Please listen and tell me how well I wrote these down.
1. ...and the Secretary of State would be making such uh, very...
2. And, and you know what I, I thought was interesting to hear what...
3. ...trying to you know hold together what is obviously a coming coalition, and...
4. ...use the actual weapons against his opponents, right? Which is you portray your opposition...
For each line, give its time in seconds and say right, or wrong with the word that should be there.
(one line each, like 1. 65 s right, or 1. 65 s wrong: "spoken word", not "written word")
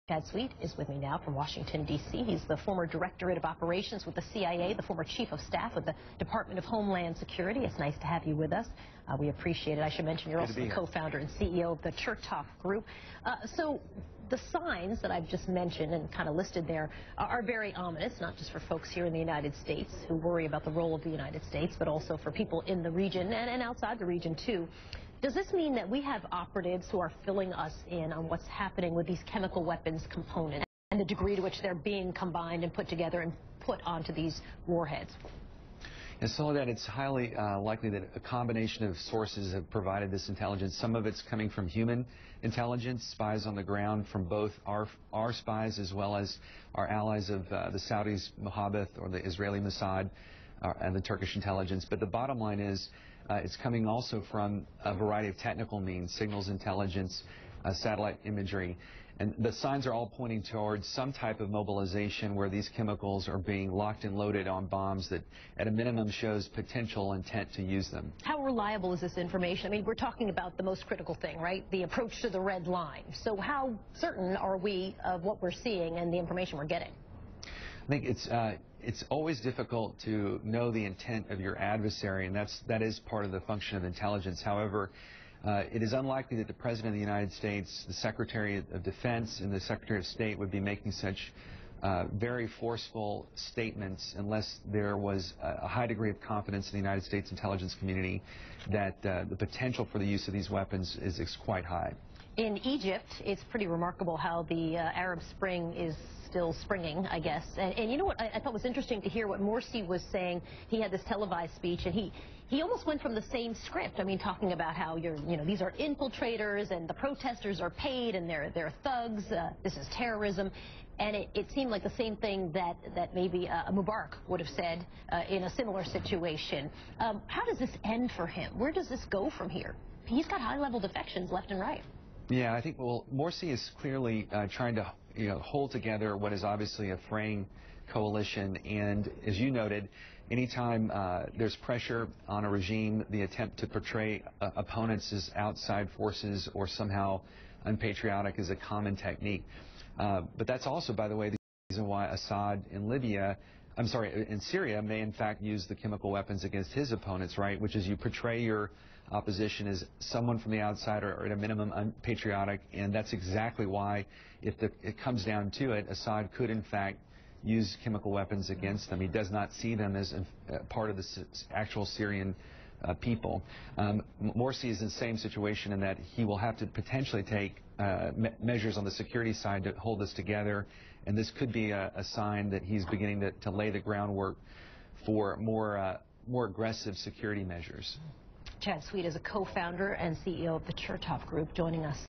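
1. 89 s right
2. 107 s right
3. 134 s wrong: "fraying", not "coming"
4. 155 s wrong: "chemical", not "actual".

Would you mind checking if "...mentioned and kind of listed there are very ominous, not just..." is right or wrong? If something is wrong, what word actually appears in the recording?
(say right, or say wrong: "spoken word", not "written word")
right.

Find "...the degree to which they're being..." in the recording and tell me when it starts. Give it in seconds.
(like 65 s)
30 s.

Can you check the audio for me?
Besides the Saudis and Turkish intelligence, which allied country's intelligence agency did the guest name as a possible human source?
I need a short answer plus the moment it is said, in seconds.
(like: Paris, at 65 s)
Israeli Mossad, at 49 s.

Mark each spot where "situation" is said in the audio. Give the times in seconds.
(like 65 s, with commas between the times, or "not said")
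125 s, 175 s.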